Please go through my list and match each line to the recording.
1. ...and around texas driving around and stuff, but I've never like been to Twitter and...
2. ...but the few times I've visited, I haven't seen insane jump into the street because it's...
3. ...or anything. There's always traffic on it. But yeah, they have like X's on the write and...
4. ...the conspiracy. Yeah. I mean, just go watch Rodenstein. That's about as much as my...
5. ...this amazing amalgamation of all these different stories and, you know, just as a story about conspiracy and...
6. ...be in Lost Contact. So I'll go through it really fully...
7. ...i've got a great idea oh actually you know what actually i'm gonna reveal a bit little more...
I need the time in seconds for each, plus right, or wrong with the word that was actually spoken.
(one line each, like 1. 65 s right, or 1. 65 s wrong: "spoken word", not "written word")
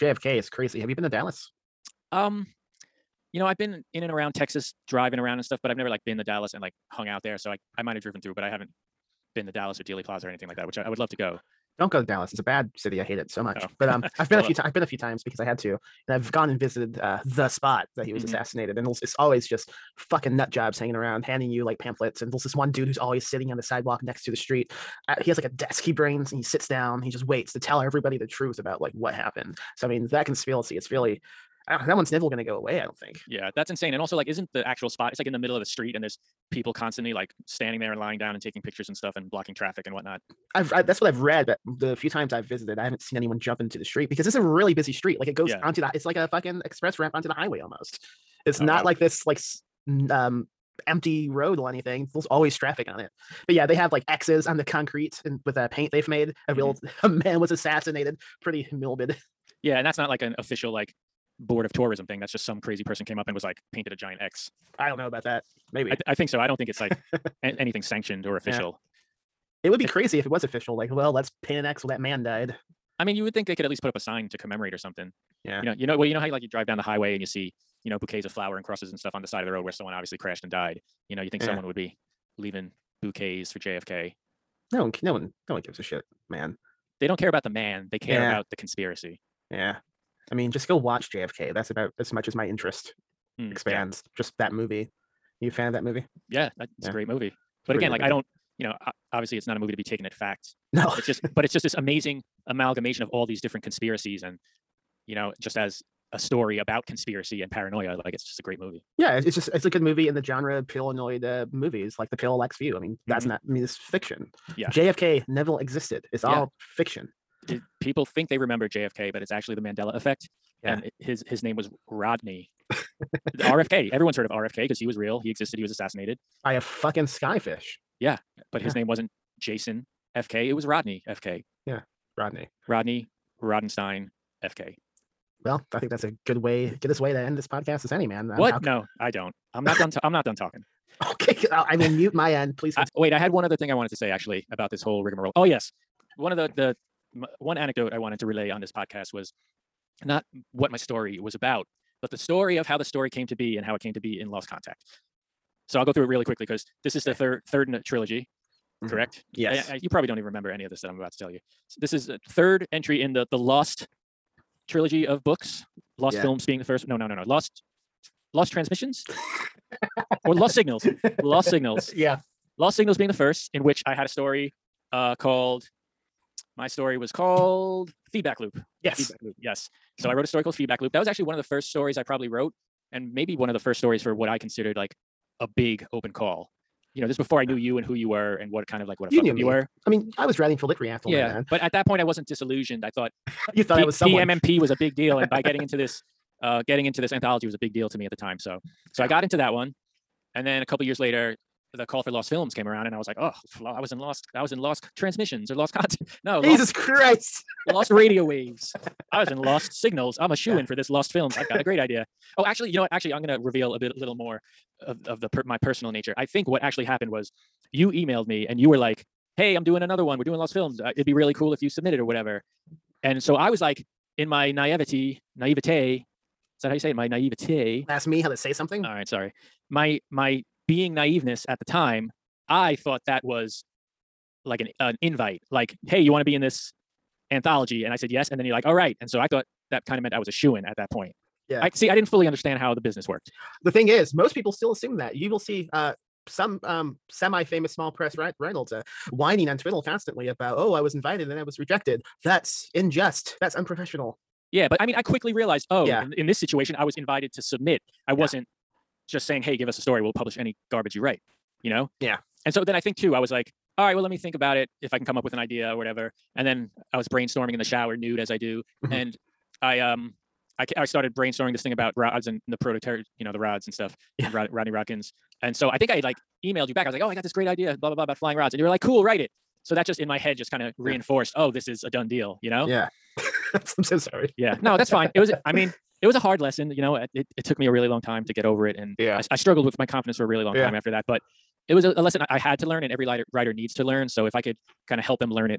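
1. 4 s wrong: "Dallas", not "Twitter"
2. 41 s wrong: "anyone", not "insane"
3. 51 s wrong: "concrete", not "write"
4. 88 s wrong: "JFK", not "Rodenstein"
5. 101 s wrong: "conspiracies", not "stories"
6. 153 s wrong: "quickly", not "fully"
7. 211 s right.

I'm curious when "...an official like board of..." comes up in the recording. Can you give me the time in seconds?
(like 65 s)
60 s.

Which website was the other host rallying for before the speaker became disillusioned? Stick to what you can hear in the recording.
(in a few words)
LitReactor.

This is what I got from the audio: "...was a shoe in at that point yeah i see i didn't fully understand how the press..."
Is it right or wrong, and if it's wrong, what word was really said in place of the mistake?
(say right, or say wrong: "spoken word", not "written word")
wrong: "business", not "press".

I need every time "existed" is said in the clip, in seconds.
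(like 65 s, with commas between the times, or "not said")
115 s, 125 s.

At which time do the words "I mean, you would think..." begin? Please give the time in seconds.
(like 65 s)
72 s.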